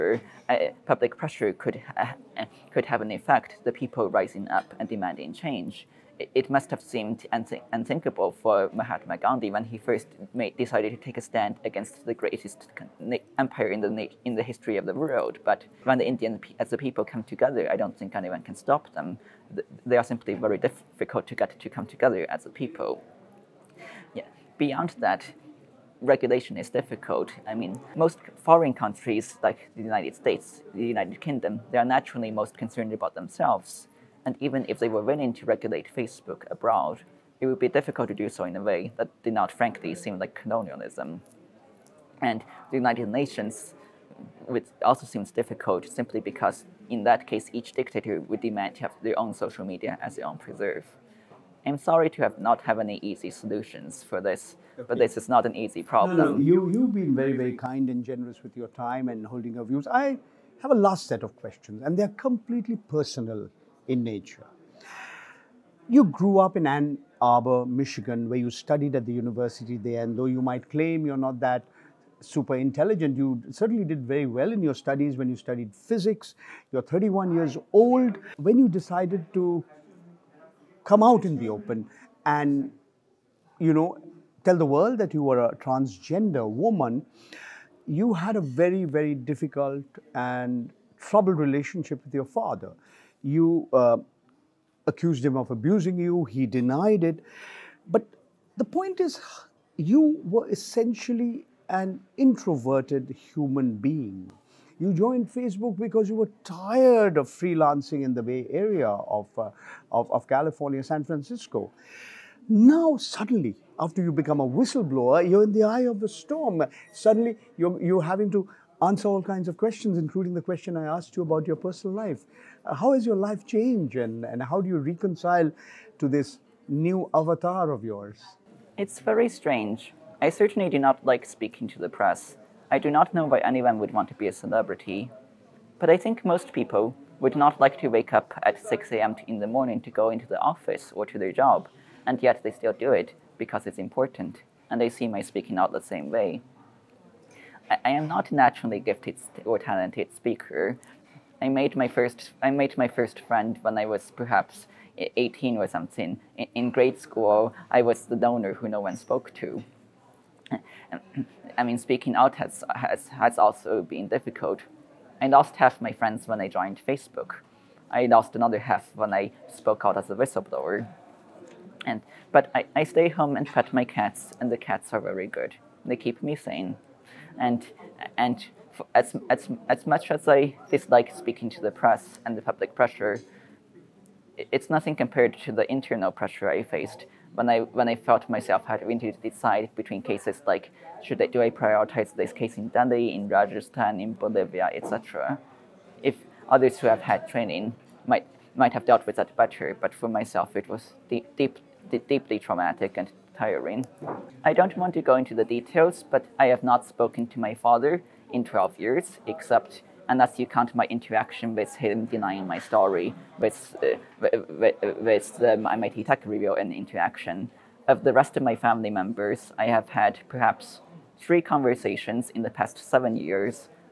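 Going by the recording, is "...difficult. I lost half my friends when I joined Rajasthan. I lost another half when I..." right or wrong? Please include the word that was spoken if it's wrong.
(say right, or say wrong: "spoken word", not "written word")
wrong: "Facebook", not "Rajasthan".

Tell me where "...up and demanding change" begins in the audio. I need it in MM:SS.
00:04.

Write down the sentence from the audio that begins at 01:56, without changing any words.
Suddenly, you're, you're having to answer all kinds of questions, including the question I asked you about your personal life.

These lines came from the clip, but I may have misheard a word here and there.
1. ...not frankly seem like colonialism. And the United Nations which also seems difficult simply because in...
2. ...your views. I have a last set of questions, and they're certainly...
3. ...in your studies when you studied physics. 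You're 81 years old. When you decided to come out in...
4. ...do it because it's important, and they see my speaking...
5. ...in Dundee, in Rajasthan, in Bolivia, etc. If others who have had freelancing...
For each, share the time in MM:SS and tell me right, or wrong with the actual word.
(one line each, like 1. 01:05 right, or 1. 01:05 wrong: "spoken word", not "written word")
1. 00:39 right
2. 00:59 wrong: "completely", not "certainly"
3. 01:14 wrong: "31", not "81"
4. 02:22 right
5. 03:12 wrong: "training", not "freelancing".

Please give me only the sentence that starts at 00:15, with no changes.
But when the Indian as the people come together, I don't think anyone can stop them.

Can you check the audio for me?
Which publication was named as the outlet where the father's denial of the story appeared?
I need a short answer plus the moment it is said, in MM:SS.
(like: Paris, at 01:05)
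MIT Tech Review, at 03:35.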